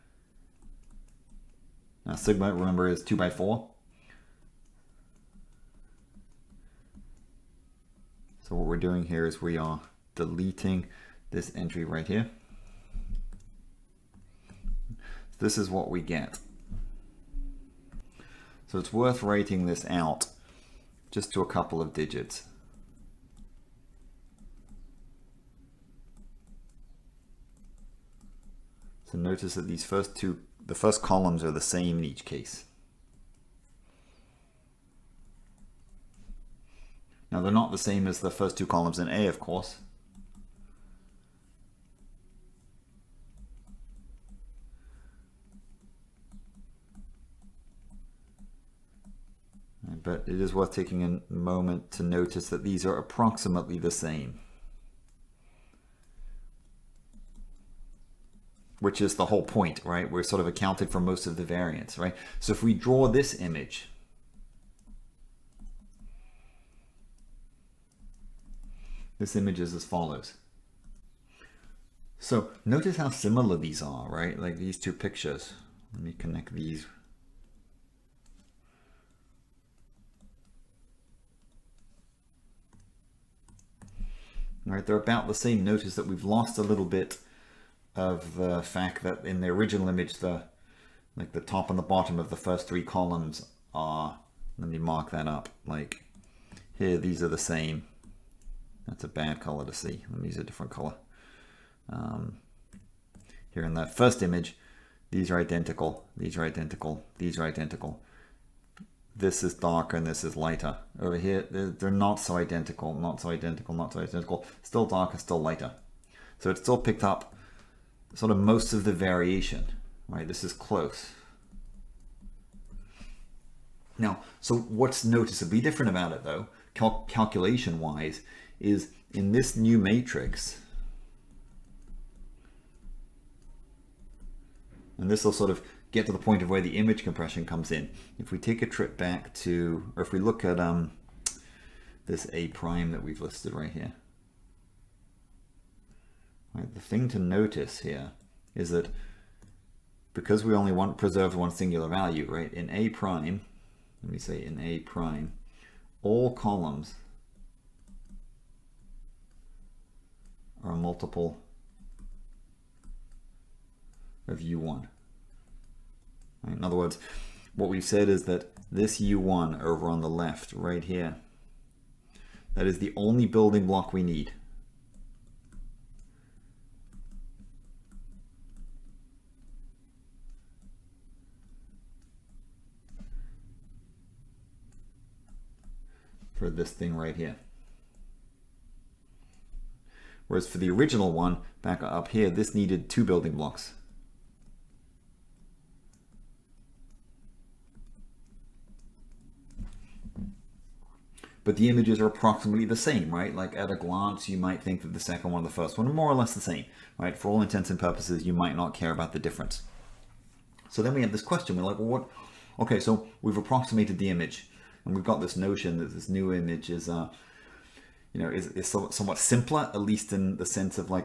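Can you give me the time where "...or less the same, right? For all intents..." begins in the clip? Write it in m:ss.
3:26.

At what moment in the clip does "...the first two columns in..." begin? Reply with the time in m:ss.
0:38.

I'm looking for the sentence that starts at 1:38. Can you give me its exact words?
That's a bad color to see.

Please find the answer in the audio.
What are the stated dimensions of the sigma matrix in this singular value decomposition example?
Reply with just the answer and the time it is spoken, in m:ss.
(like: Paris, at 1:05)
2 by 4, at 0:03.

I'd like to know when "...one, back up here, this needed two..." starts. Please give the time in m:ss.
3:11.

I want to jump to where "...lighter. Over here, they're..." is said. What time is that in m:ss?
1:50.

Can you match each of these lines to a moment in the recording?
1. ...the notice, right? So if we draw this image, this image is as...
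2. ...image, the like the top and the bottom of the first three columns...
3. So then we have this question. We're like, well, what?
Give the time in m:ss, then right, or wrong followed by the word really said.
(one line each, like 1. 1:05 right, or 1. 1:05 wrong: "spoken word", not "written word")
1. 1:01 wrong: "variance", not "notice"
2. 1:29 right
3. 3:30 right.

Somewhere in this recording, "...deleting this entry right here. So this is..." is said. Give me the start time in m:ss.
0:10.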